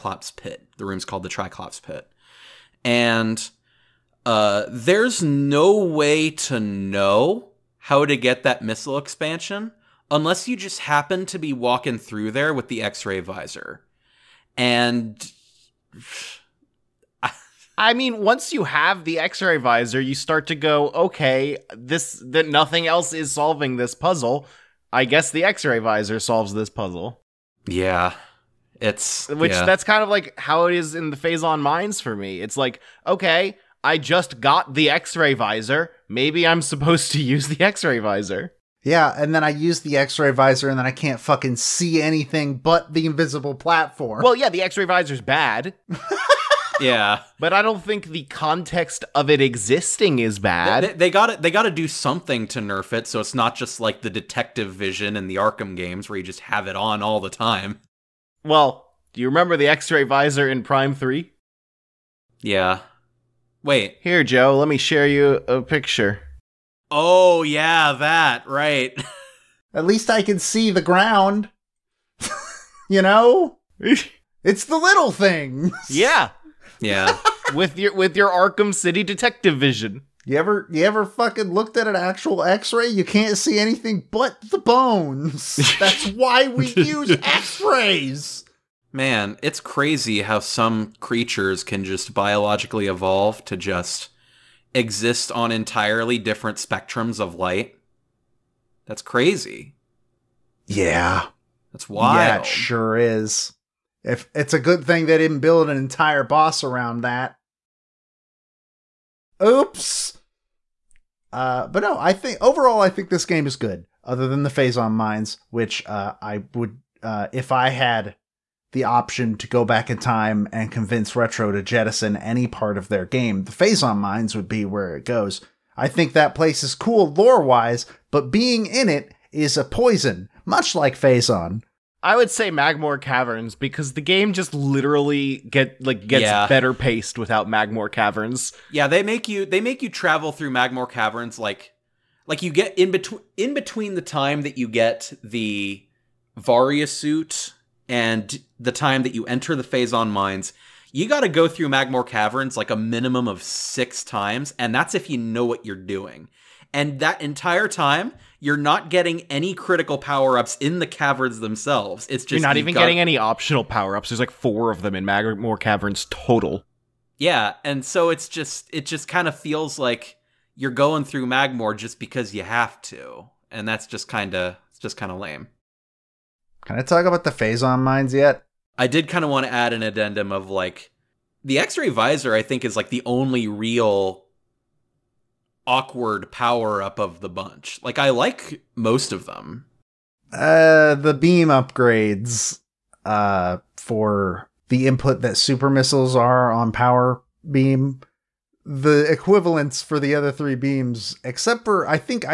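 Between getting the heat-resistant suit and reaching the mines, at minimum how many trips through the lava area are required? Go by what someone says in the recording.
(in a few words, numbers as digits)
6.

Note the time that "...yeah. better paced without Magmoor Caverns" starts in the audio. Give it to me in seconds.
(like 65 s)
136 s.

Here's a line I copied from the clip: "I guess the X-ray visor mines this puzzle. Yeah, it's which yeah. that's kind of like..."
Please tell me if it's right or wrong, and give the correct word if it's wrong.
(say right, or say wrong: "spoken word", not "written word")
wrong: "solves", not "mines".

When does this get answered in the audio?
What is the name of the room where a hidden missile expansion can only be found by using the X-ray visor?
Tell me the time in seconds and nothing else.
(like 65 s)
1 s.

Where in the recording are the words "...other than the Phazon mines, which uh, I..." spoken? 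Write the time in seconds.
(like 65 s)
114 s.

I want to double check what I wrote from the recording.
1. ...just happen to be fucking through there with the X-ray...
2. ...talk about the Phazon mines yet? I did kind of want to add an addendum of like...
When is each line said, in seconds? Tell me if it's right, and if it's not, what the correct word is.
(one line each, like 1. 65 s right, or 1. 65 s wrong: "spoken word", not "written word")
1. 10 s wrong: "walking", not "fucking"
2. 176 s right.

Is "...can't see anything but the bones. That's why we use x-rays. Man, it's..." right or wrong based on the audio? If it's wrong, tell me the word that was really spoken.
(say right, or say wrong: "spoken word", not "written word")
right.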